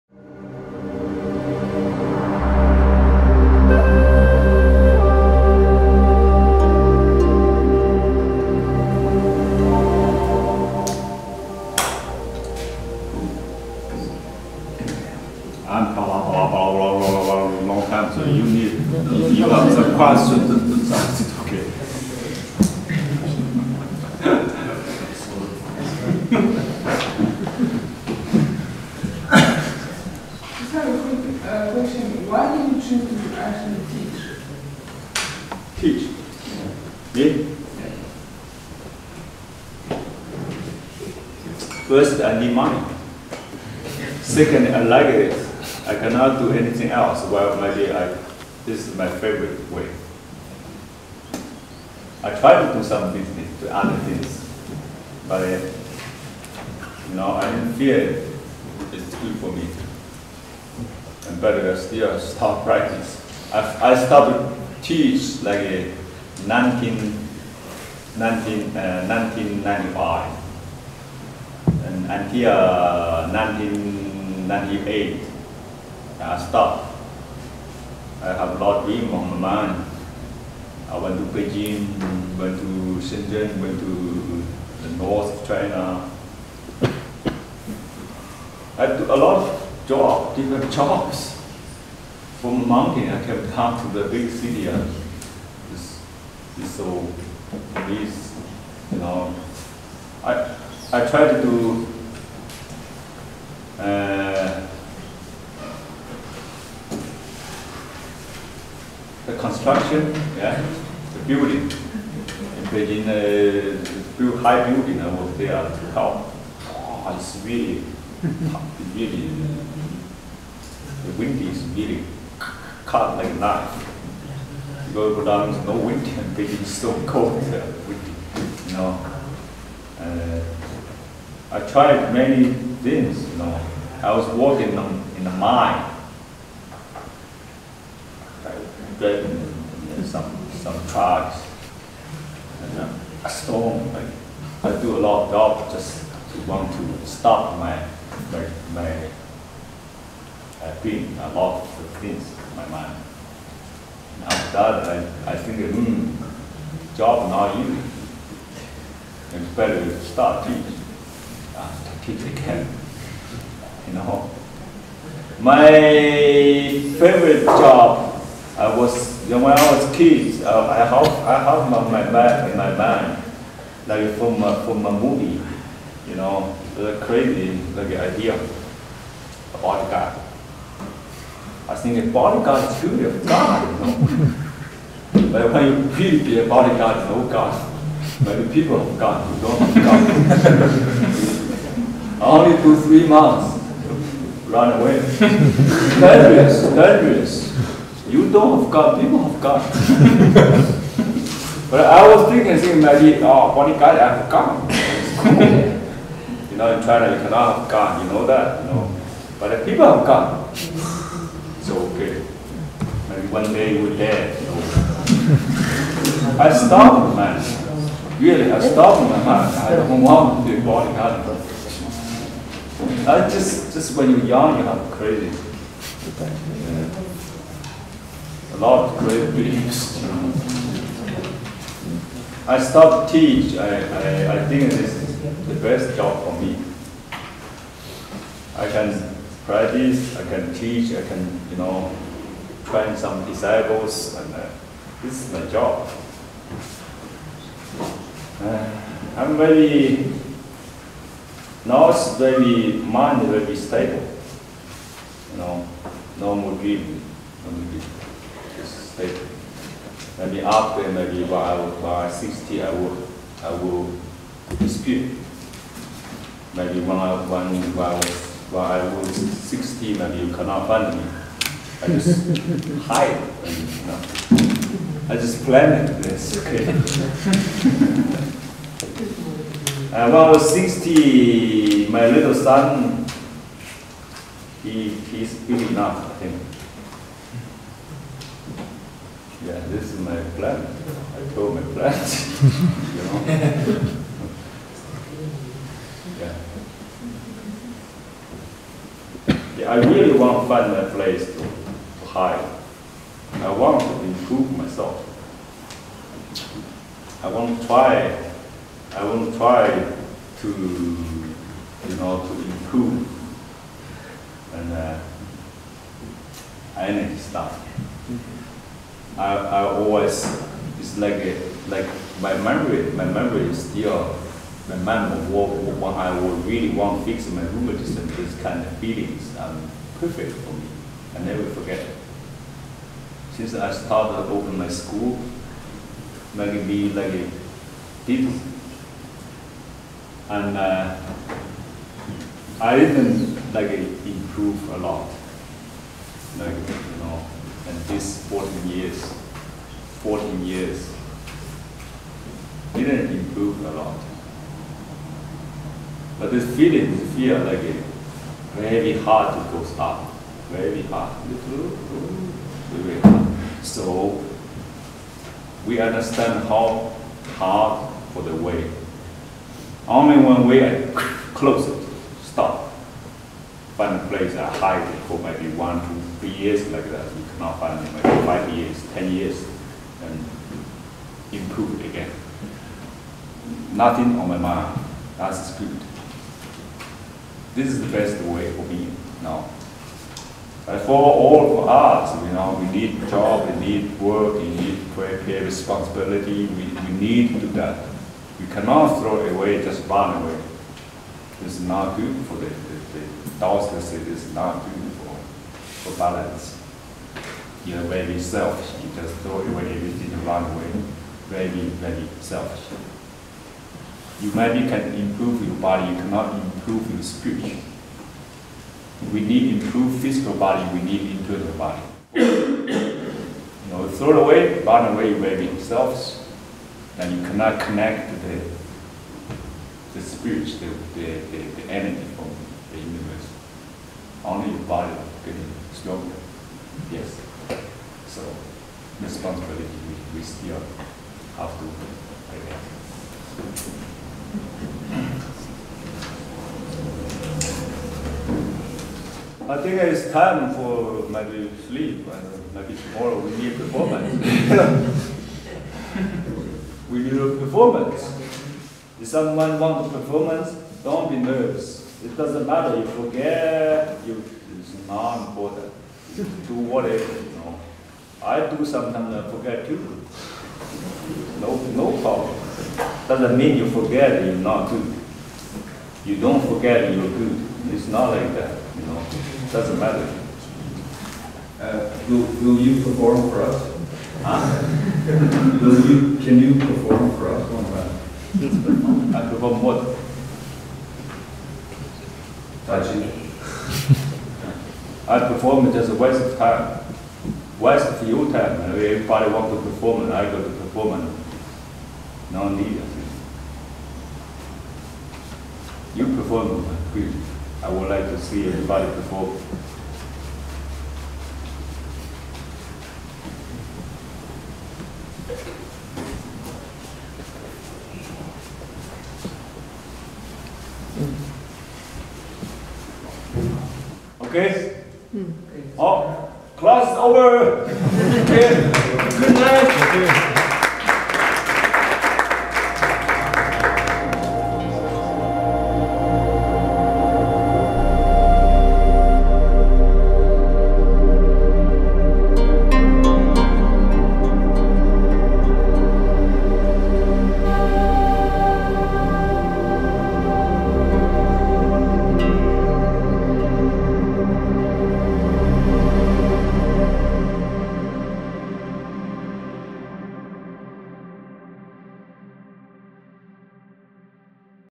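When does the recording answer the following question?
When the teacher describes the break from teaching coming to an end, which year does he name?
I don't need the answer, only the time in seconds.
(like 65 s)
73 s.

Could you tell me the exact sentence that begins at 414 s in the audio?
You maybe can improve your body, you cannot improve your spirit.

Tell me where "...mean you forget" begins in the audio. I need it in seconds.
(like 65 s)
473 s.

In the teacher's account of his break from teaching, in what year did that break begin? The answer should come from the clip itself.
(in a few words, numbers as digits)
1995.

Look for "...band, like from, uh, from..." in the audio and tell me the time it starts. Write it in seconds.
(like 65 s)
172 s.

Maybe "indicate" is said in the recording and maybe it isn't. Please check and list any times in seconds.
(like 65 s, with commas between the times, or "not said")
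not said.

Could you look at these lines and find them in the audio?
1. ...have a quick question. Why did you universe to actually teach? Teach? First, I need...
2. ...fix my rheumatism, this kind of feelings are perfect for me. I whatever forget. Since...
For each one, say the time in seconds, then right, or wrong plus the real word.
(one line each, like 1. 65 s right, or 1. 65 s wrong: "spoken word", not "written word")
1. 30 s wrong: "choose", not "universe"
2. 327 s wrong: "never", not "whatever".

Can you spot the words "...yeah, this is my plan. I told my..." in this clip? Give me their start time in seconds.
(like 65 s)
289 s.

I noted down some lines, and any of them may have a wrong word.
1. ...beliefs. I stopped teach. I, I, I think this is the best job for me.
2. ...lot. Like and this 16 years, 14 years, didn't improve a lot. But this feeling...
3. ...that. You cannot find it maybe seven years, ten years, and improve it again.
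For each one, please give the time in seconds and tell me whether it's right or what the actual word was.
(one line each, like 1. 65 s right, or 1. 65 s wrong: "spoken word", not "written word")
1. 229 s right
2. 344 s wrong: "14", not "16"
3. 376 s wrong: "five", not "seven".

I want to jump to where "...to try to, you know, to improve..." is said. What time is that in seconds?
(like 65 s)
309 s.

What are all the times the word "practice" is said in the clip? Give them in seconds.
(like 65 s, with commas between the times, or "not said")
62 s, 239 s.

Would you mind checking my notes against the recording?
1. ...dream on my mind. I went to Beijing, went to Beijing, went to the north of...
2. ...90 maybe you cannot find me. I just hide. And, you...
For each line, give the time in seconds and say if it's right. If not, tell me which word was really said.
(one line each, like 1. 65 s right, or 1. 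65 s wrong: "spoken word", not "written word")
1. 78 s wrong: "Shenzhen", not "Beijing"
2. 269 s wrong: "60", not "90".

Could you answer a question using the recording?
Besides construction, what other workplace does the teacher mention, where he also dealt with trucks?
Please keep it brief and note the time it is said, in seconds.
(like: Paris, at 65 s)
The mine, at 135 s.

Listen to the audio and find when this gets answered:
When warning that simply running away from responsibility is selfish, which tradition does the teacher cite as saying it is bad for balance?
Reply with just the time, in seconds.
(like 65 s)
403 s.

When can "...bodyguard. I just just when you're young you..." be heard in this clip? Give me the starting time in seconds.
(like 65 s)
220 s.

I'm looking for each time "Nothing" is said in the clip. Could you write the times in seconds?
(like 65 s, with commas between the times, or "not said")
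383 s.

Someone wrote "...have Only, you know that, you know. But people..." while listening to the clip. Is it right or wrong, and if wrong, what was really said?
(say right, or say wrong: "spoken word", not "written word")
wrong: "God", not "Only".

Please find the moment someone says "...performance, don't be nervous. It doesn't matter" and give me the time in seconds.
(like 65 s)
459 s.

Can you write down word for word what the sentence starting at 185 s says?
but when you really be a bodyguard, no God.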